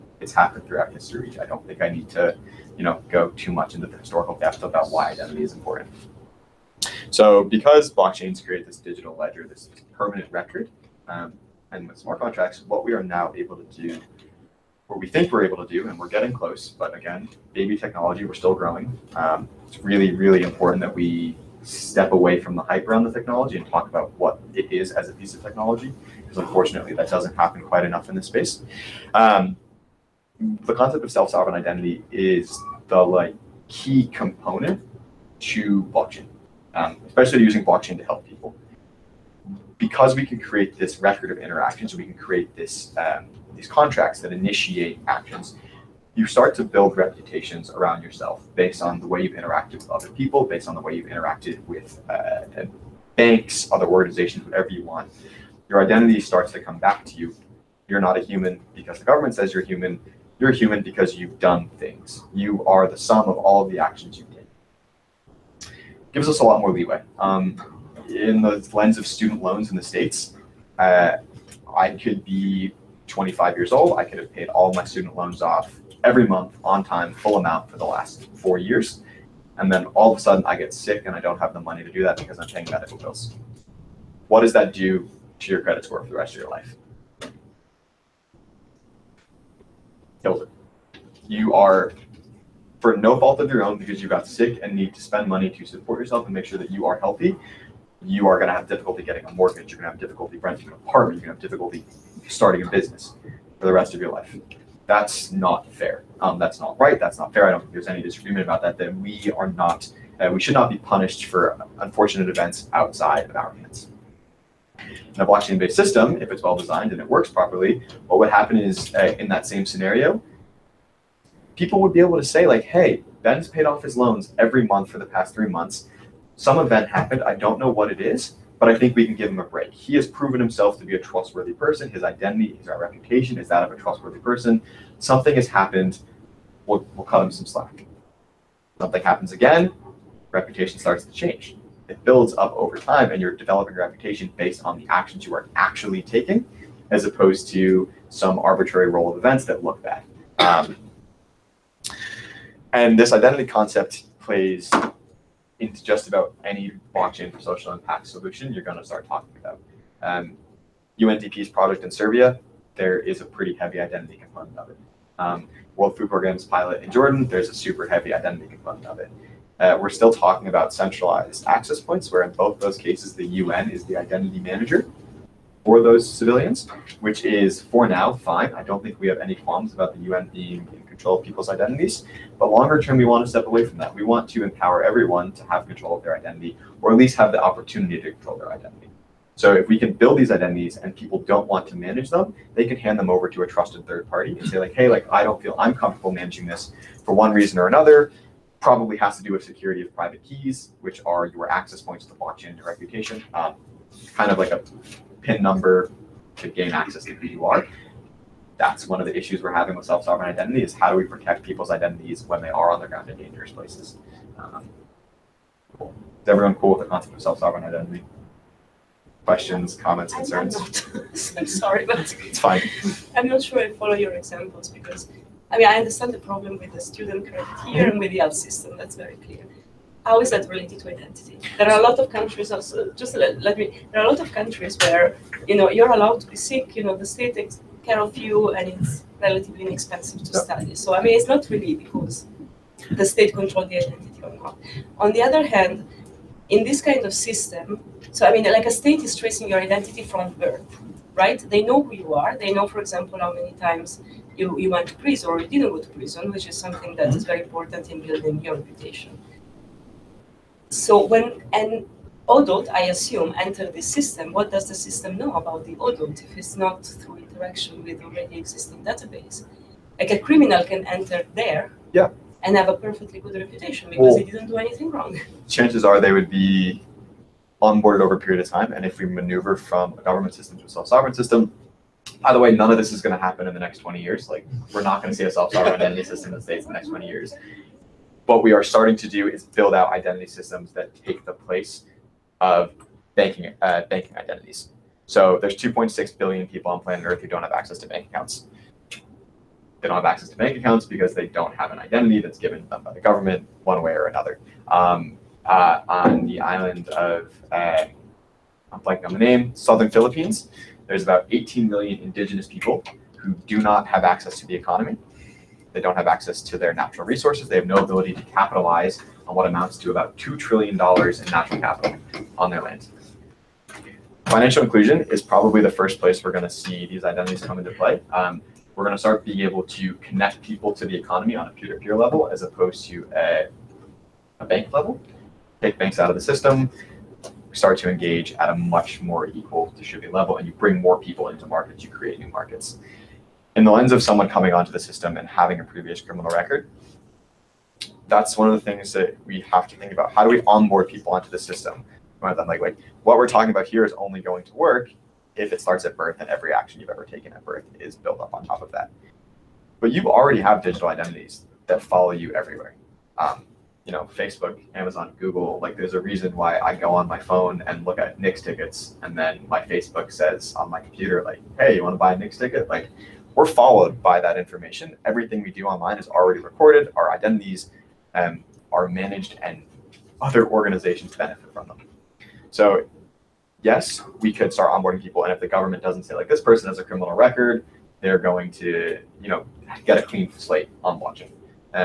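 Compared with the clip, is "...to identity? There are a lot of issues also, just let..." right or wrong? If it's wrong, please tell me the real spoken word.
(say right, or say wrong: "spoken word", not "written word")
wrong: "countries", not "issues".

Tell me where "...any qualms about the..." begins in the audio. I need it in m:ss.
2:59.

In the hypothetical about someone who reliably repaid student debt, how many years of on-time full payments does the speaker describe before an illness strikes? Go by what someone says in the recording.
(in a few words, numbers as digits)
4 years.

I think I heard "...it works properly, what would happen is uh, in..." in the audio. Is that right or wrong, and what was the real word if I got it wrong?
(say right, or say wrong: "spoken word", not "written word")
right.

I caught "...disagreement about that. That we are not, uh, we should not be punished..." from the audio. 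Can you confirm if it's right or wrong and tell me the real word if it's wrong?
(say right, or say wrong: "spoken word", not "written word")
right.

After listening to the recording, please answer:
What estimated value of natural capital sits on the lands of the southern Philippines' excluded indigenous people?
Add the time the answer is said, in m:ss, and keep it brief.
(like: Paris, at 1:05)
$2 trillion, at 5:20.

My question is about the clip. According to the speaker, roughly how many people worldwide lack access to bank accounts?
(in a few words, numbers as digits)
2.6 billion.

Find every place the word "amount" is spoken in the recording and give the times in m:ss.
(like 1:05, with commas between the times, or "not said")
1:17, 5:19.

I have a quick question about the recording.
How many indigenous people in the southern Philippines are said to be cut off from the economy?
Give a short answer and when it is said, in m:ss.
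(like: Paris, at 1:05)
18 million, at 5:11.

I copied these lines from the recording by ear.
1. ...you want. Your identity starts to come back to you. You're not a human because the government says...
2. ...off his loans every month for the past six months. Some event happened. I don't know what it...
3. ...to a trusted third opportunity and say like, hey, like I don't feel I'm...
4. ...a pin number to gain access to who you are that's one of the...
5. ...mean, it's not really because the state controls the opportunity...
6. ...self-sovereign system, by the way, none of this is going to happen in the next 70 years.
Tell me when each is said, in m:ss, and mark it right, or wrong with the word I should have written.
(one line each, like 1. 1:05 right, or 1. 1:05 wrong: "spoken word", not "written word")
1. 0:54 right
2. 2:03 wrong: "three", not "six"
3. 3:13 wrong: "party", not "opportunity"
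4. 3:24 right
5. 4:01 wrong: "identity", not "opportunity"
6. 4:40 wrong: "20", not "70".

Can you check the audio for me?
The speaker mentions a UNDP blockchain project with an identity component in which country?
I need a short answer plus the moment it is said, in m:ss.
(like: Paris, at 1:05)
Serbia, at 2:41.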